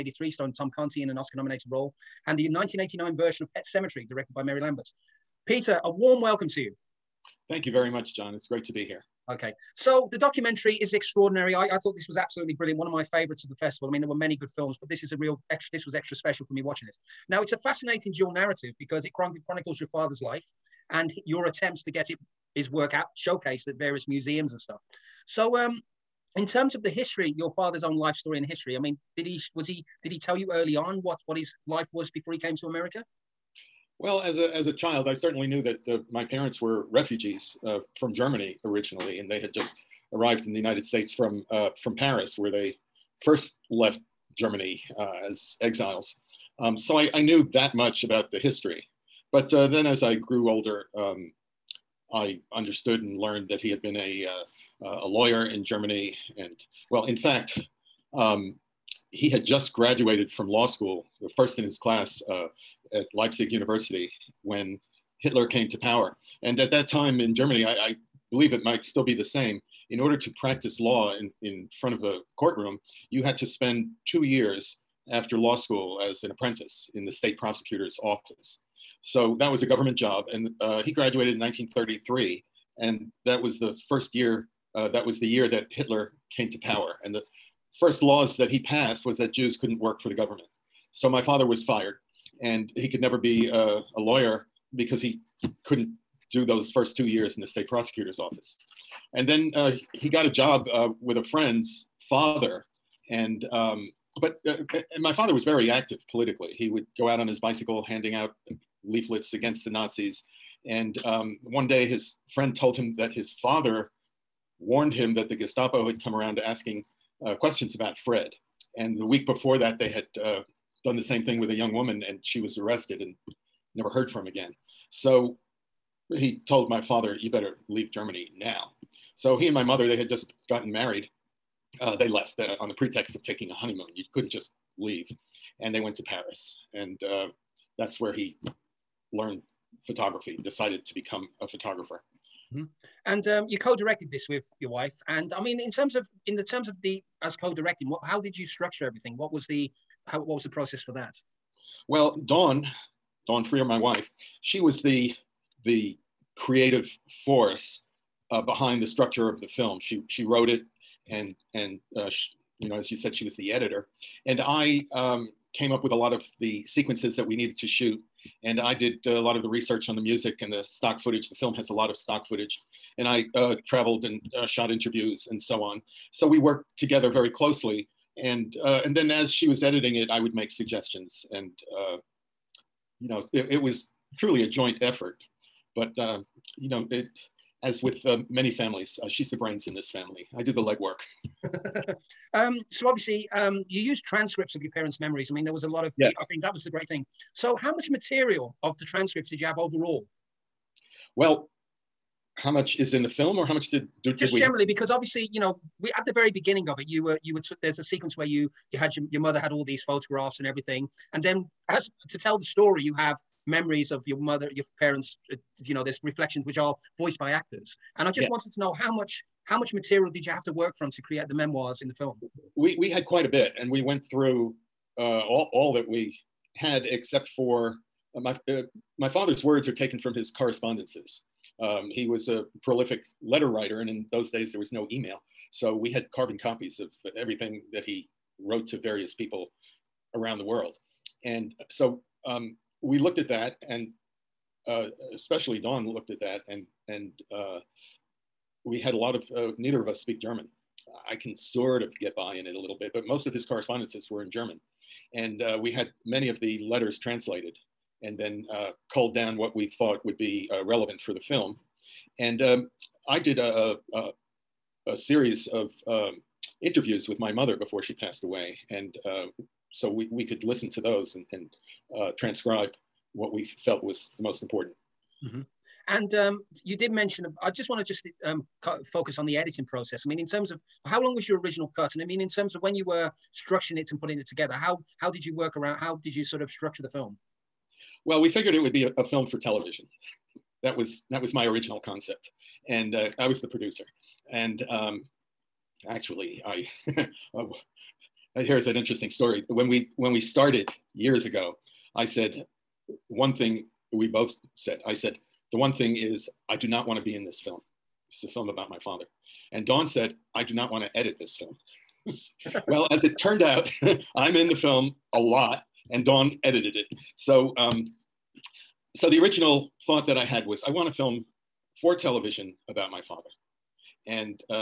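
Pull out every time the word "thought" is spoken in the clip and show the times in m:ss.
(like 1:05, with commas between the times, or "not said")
0:11, 4:19, 5:19.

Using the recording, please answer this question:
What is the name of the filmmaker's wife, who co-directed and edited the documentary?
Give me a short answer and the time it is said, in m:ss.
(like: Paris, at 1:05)
Dawn Freer, at 2:33.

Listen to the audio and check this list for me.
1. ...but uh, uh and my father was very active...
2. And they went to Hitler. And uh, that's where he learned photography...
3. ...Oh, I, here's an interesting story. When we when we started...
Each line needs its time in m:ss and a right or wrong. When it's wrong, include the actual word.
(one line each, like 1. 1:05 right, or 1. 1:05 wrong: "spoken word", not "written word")
1. 1:44 right
2. 2:15 wrong: "Paris", not "Hitler"
3. 4:57 right.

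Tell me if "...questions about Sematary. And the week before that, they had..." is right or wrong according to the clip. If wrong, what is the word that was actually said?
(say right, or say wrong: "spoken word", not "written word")
wrong: "Fred", not "Sematary".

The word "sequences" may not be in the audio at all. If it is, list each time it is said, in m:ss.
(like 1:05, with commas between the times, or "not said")
2:46, 3:27.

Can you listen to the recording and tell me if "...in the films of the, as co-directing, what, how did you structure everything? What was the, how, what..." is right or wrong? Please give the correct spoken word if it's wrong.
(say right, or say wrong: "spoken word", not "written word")
wrong: "terms", not "films".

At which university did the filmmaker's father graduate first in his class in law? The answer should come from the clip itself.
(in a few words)
Leipzig University.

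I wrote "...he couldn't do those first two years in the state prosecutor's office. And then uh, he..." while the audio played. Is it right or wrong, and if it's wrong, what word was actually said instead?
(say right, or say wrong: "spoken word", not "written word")
right.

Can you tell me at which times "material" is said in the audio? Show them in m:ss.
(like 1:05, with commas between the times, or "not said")
3:17, 3:39.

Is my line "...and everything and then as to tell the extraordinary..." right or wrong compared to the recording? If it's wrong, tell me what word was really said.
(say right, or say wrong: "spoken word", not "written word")
wrong: "story", not "extraordinary".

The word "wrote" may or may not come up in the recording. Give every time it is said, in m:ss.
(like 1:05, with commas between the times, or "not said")
2:40, 3:58.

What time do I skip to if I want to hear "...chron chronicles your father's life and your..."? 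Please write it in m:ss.
0:19.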